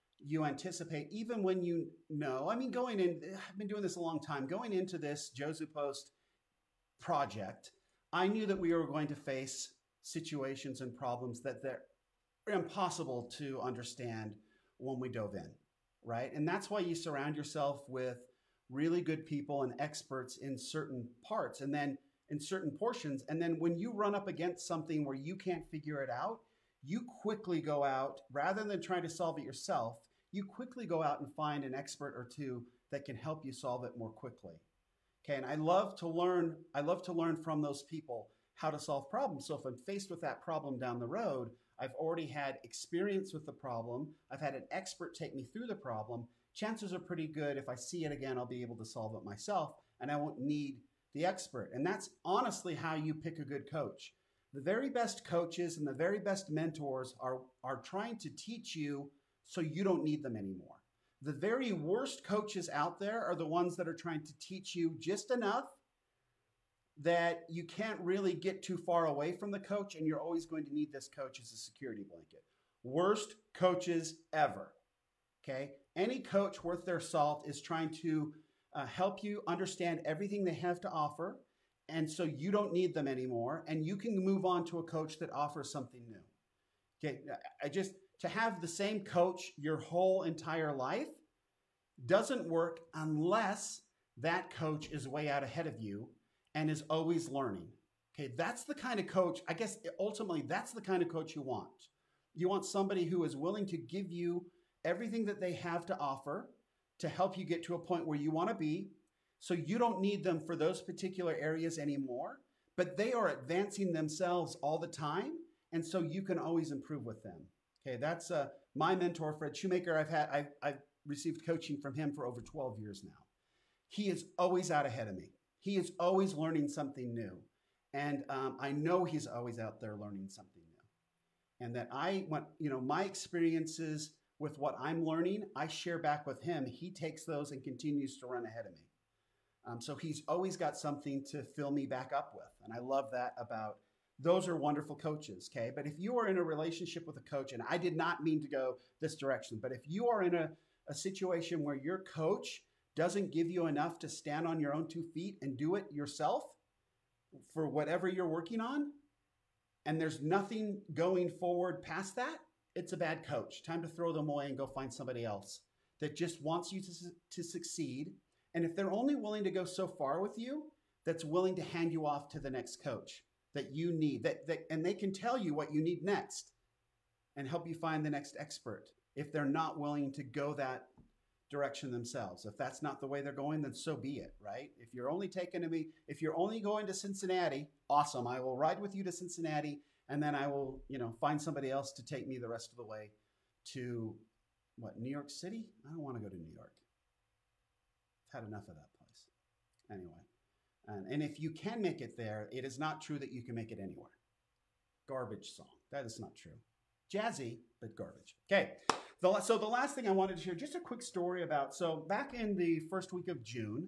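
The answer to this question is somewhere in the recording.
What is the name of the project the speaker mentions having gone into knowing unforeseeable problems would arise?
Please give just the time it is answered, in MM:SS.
00:05.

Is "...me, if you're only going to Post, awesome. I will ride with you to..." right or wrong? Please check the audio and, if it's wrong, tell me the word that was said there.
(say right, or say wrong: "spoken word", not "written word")
wrong: "Cincinnati", not "Post".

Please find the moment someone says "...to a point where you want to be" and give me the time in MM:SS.
01:47.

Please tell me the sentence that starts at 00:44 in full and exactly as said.
I've had an expert take me through the problem.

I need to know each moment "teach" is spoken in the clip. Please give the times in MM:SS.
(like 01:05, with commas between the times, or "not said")
00:58, 01:04.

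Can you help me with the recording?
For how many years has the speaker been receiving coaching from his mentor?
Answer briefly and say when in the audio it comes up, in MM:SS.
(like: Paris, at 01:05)
over 12 years, at 02:02.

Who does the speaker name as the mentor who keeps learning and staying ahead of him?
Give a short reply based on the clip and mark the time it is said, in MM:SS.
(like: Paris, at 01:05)
Fred Shoemaker, at 01:59.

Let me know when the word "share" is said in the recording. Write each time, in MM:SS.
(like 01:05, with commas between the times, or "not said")
02:15, 03:30.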